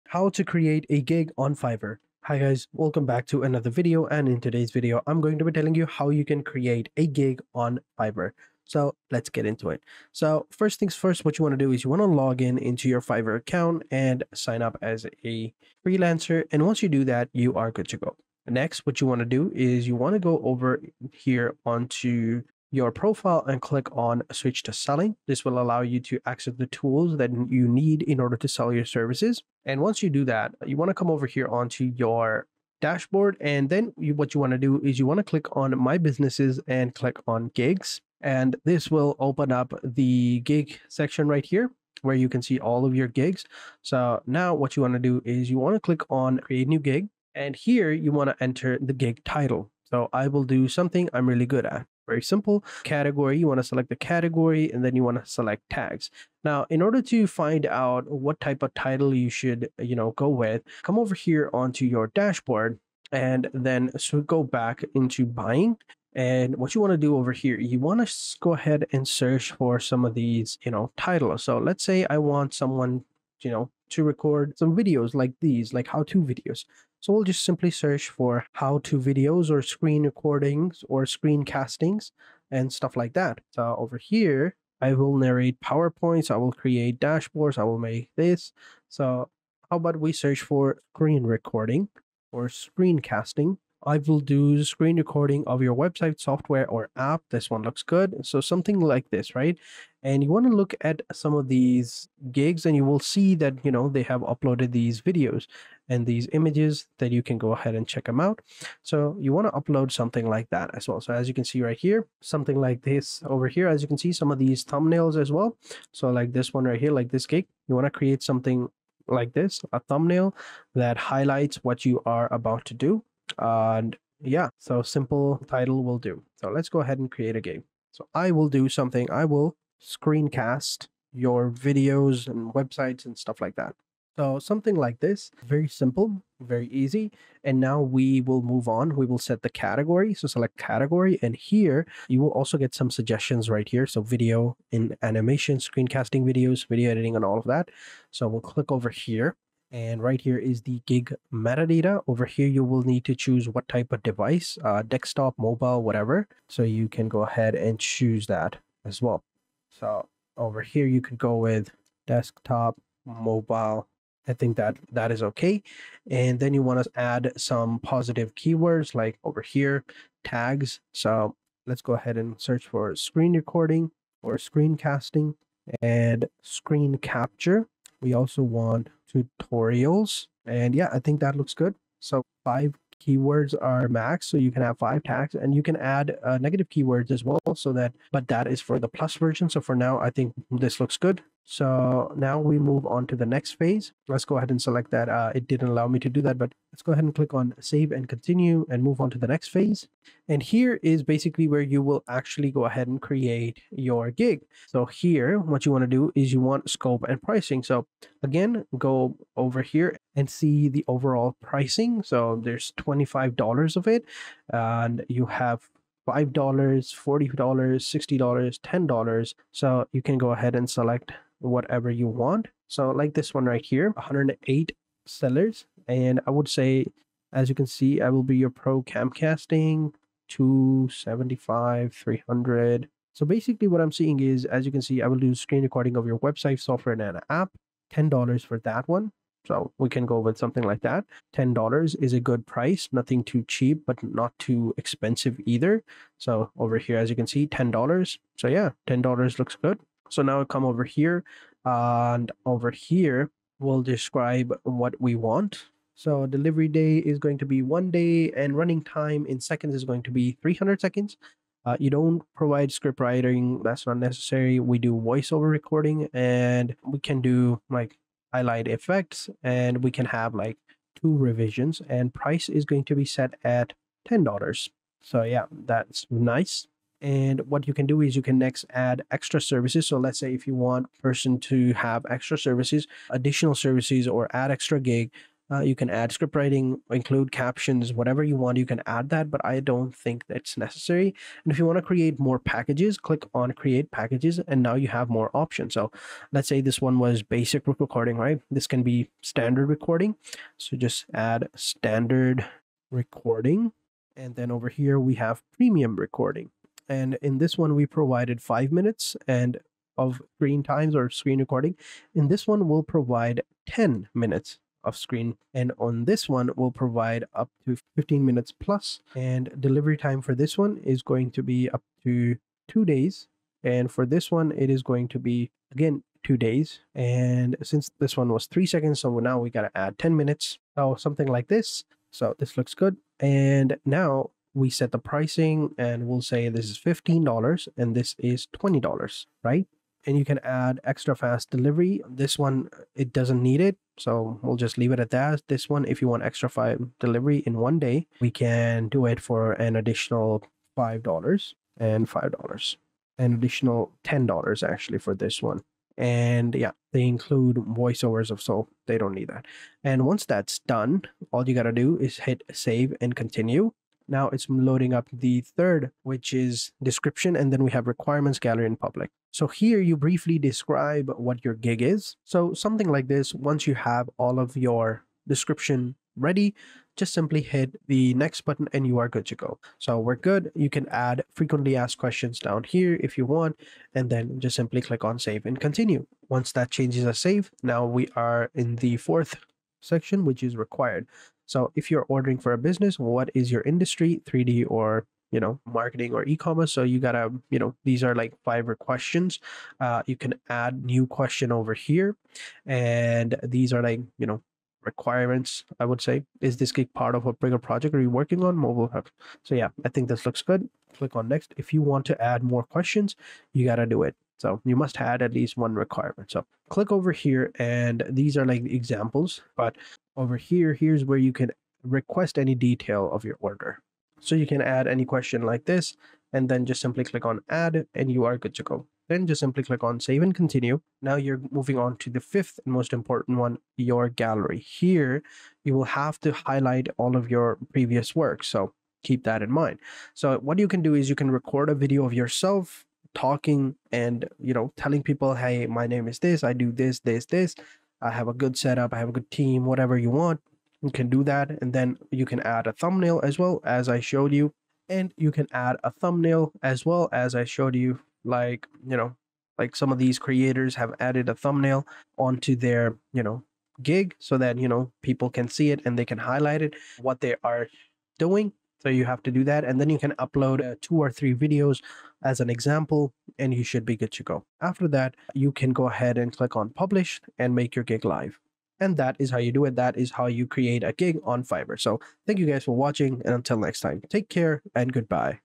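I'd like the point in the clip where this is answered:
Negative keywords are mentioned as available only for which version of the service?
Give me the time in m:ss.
3:08.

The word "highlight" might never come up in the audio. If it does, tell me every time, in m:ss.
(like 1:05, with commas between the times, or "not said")
2:00, 4:28, 7:16, 7:46.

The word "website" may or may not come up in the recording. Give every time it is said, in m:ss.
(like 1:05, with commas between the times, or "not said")
1:35, 2:12, 3:56.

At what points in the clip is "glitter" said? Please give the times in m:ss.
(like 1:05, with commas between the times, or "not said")
not said.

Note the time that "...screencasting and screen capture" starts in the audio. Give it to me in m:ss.
2:54.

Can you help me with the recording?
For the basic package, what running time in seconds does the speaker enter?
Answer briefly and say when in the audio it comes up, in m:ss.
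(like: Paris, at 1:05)
300, at 4:20.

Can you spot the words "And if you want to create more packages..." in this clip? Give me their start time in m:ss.
4:51.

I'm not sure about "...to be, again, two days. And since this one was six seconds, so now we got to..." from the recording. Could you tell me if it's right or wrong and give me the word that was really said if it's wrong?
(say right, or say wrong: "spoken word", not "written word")
wrong: "three", not "six".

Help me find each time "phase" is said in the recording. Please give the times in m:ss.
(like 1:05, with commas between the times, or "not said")
3:13, 3:19.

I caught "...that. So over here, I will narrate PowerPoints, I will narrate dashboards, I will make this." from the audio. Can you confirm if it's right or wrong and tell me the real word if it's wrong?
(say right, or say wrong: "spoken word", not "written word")
wrong: "create", not "narrate".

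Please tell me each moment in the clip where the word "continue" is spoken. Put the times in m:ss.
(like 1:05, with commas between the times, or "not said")
3:18, 6:03, 6:25, 7:10.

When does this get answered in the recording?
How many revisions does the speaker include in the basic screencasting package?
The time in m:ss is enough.
4:31.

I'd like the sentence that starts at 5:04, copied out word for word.
And then over here, we have premium recording.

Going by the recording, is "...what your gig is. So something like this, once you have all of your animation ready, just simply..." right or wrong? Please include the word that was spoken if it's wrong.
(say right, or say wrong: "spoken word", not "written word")
wrong: "description", not "animation".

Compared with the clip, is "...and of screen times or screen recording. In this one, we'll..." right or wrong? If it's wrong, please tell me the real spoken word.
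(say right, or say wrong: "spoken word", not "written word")
right.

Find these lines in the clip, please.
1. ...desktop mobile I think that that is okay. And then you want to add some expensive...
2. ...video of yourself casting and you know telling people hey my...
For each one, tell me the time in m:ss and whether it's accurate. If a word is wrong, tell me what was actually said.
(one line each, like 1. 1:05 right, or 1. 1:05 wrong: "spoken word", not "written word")
1. 2:42 wrong: "positive", not "expensive"
2. 7:21 wrong: "talking", not "casting".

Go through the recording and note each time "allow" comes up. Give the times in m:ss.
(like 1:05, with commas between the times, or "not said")
0:25, 3:15.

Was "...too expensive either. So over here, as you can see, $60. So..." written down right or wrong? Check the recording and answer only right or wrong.
wrong.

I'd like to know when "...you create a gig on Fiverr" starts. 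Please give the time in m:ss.
8:00.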